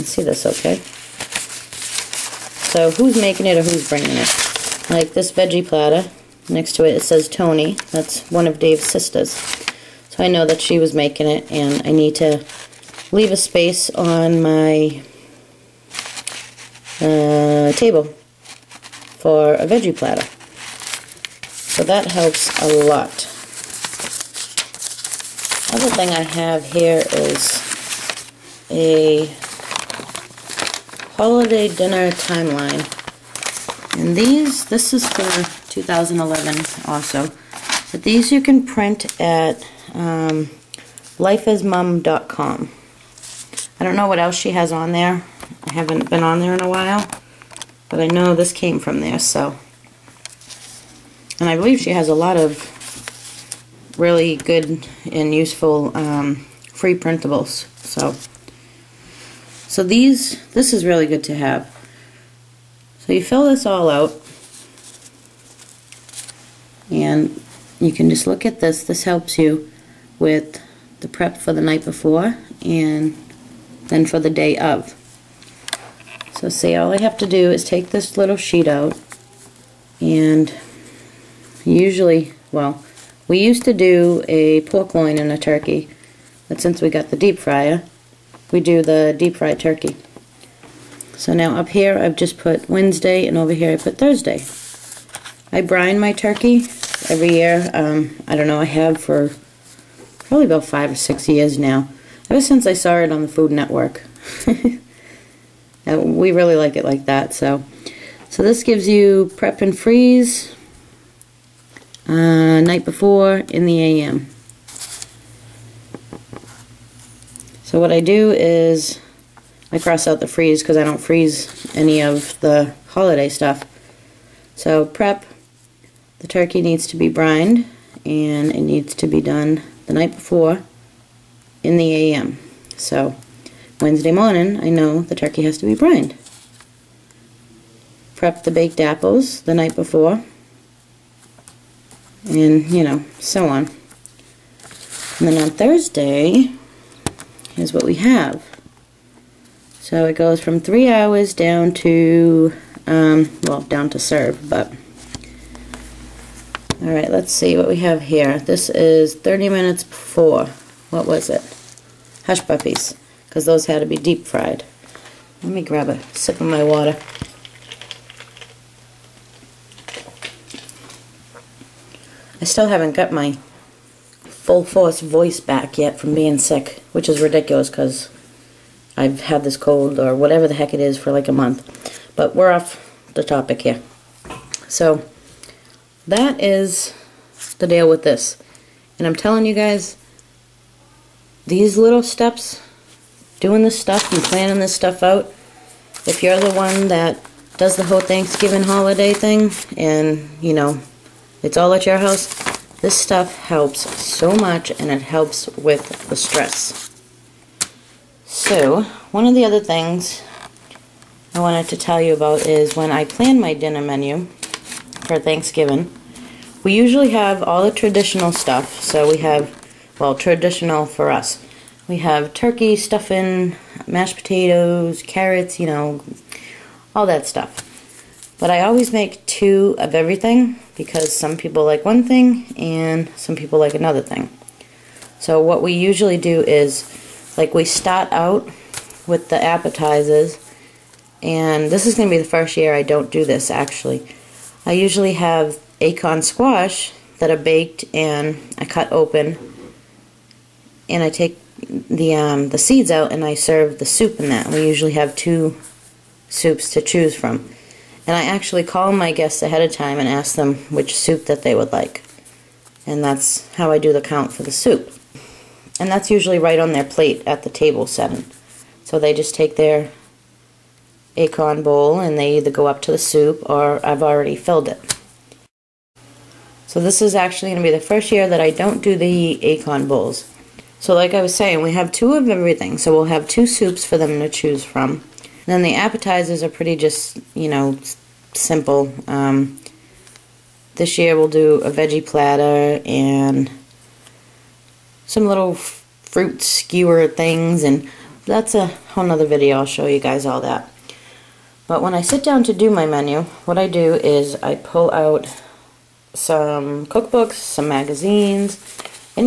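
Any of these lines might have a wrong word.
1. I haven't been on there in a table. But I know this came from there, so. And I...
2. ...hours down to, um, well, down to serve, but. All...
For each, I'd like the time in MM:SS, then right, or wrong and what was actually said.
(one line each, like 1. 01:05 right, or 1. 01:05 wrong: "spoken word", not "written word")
1. 00:45 wrong: "while", not "table"
2. 02:30 right.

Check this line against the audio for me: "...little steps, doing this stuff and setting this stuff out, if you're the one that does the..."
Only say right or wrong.
wrong.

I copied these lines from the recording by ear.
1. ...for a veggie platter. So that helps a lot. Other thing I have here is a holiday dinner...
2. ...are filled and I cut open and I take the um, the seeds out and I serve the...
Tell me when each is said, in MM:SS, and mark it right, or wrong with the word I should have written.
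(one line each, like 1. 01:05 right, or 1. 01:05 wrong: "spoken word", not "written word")
1. 00:19 right
2. 04:07 wrong: "baked", not "filled".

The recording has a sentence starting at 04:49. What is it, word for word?
Um, this year we'll do a veggie platter and some little fruit skewer things and that's a whole nother video.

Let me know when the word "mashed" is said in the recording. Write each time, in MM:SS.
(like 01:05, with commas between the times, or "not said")
03:43.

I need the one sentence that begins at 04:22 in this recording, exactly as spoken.
And that's how I do the count for the soup.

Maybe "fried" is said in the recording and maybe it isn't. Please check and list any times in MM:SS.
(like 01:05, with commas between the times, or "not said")
01:29, 02:44.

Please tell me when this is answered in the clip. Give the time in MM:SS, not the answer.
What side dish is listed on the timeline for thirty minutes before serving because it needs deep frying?
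02:42.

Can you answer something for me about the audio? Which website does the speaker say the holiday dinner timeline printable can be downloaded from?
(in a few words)
lifeasmom.com.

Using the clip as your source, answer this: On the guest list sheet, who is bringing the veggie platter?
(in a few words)
Tony.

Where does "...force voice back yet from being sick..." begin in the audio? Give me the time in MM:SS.
02:54.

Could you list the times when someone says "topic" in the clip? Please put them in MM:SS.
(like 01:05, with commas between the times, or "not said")
03:03.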